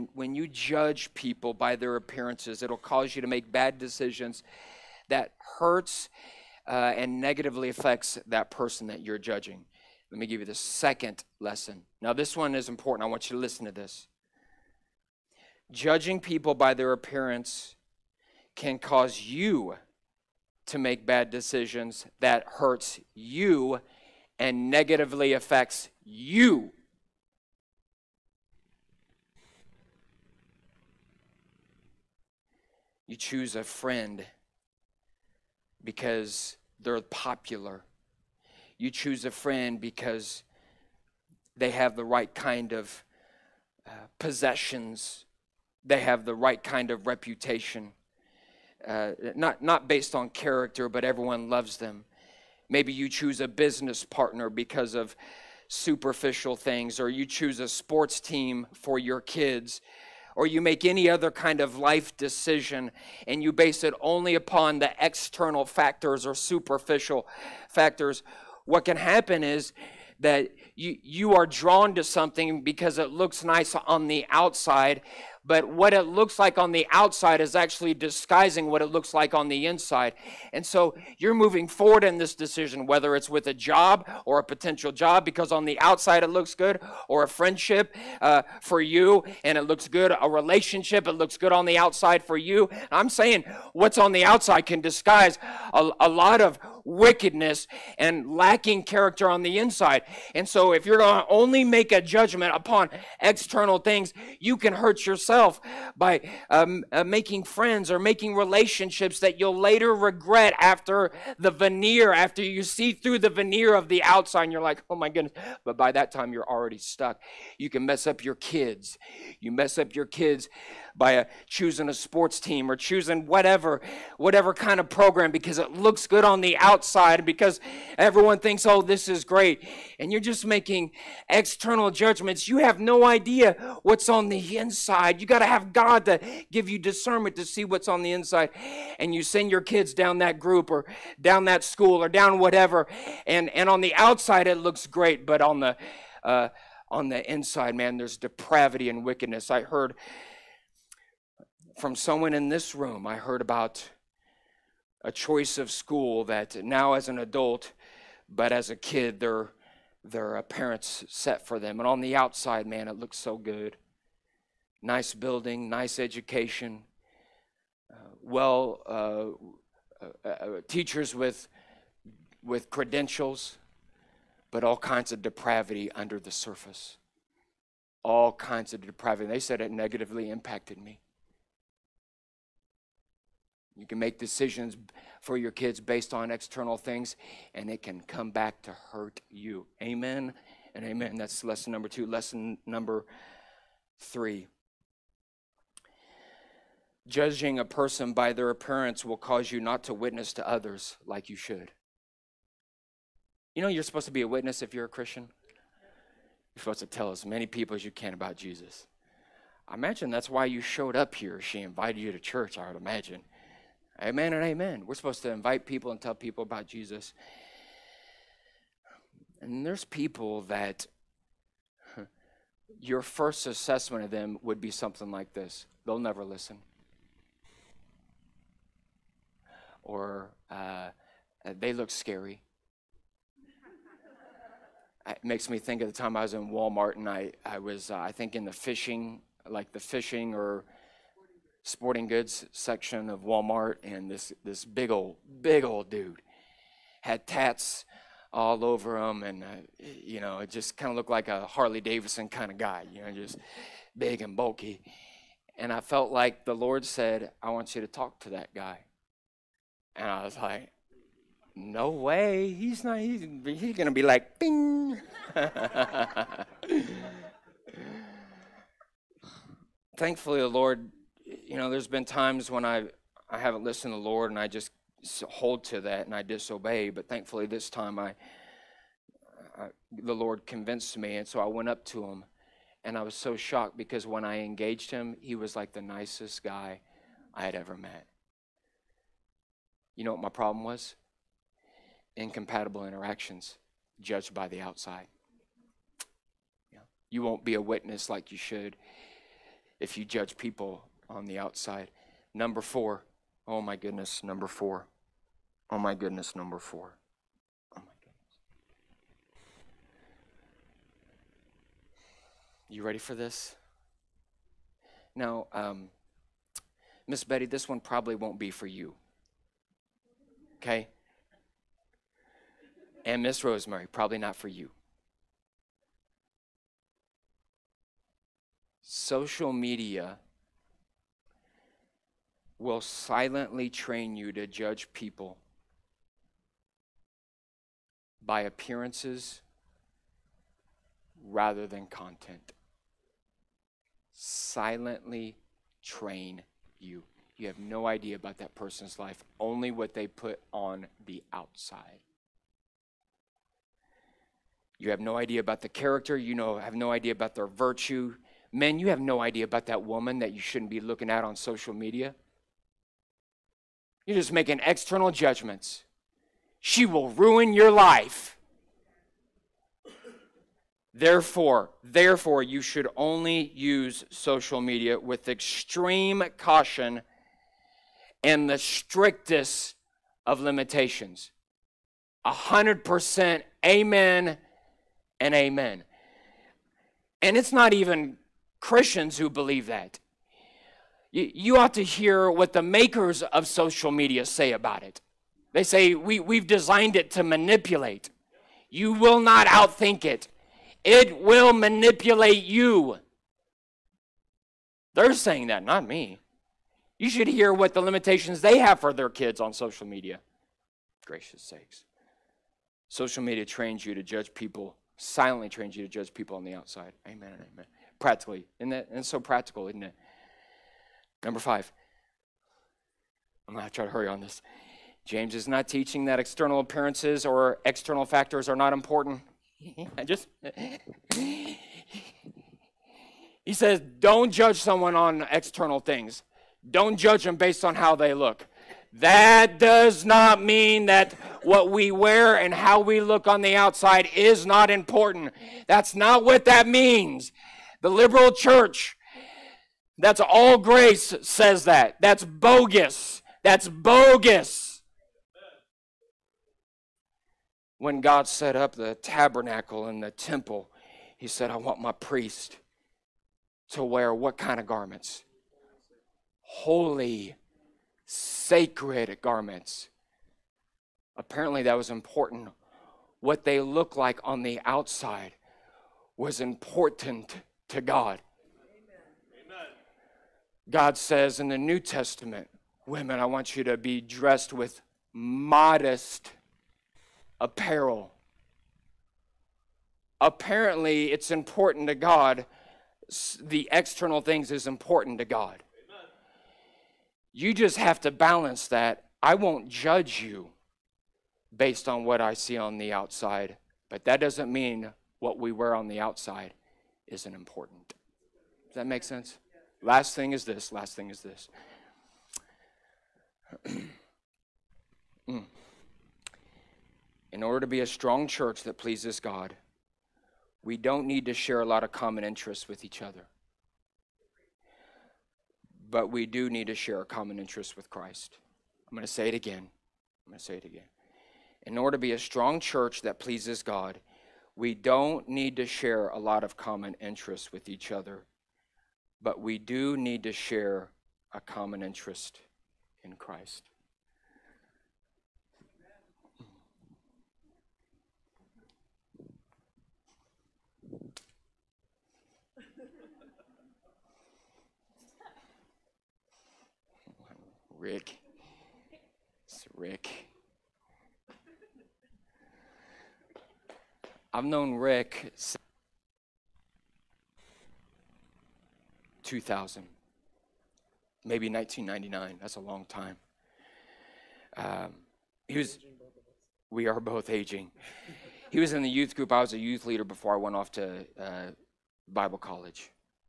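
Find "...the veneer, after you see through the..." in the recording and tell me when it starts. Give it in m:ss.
1:51.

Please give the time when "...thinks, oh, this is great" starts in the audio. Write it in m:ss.
2:08.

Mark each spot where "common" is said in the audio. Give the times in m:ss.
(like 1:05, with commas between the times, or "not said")
8:41, 8:47, 8:56, 9:01.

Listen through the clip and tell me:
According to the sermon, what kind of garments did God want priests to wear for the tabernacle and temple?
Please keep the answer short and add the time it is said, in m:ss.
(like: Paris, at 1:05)
Holy, sacred garments, at 7:46.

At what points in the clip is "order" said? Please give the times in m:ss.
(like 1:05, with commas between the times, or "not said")
8:37, 8:51.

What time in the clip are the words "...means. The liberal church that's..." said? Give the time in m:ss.
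7:26.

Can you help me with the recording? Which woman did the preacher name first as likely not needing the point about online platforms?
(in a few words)
Miss Betty.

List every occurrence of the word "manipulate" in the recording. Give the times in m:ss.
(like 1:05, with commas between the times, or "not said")
6:37, 6:41.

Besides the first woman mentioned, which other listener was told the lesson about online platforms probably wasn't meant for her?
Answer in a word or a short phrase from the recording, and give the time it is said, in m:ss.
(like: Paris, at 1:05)
Miss Rosemary, at 5:23.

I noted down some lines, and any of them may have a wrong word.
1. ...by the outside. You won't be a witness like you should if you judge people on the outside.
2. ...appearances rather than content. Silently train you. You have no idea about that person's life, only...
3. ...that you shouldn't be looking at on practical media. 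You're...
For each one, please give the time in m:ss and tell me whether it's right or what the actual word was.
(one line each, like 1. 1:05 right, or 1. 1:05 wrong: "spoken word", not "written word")
1. 4:54 right
2. 5:38 right
3. 6:00 wrong: "social", not "practical".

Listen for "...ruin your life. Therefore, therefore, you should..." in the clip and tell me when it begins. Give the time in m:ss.
6:07.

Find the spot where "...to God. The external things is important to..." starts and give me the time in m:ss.
8:11.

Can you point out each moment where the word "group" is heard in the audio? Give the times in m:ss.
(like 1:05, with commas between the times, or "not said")
2:20, 9:39.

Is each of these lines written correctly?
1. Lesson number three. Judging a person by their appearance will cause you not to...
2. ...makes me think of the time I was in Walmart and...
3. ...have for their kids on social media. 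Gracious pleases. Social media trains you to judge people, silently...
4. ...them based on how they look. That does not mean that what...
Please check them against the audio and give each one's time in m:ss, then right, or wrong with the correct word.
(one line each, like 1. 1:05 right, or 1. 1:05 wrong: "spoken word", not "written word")
1. 3:12 right
2. 3:55 right
3. 6:48 wrong: "sakes", not "pleases"
4. 7:17 right.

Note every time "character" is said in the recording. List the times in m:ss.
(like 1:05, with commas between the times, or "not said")
0:50, 1:38, 5:55.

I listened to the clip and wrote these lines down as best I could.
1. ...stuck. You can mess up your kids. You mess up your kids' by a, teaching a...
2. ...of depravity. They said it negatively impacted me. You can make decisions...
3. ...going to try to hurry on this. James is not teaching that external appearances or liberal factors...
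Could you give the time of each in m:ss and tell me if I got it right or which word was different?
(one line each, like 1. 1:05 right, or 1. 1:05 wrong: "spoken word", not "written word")
1. 1:56 wrong: "choosing", not "teaching"
2. 2:58 right
3. 7:03 wrong: "external", not "liberal".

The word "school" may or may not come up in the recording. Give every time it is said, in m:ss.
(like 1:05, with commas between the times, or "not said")
2:21, 2:35.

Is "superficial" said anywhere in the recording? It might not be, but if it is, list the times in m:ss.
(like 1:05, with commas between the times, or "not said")
0:55, 1:06.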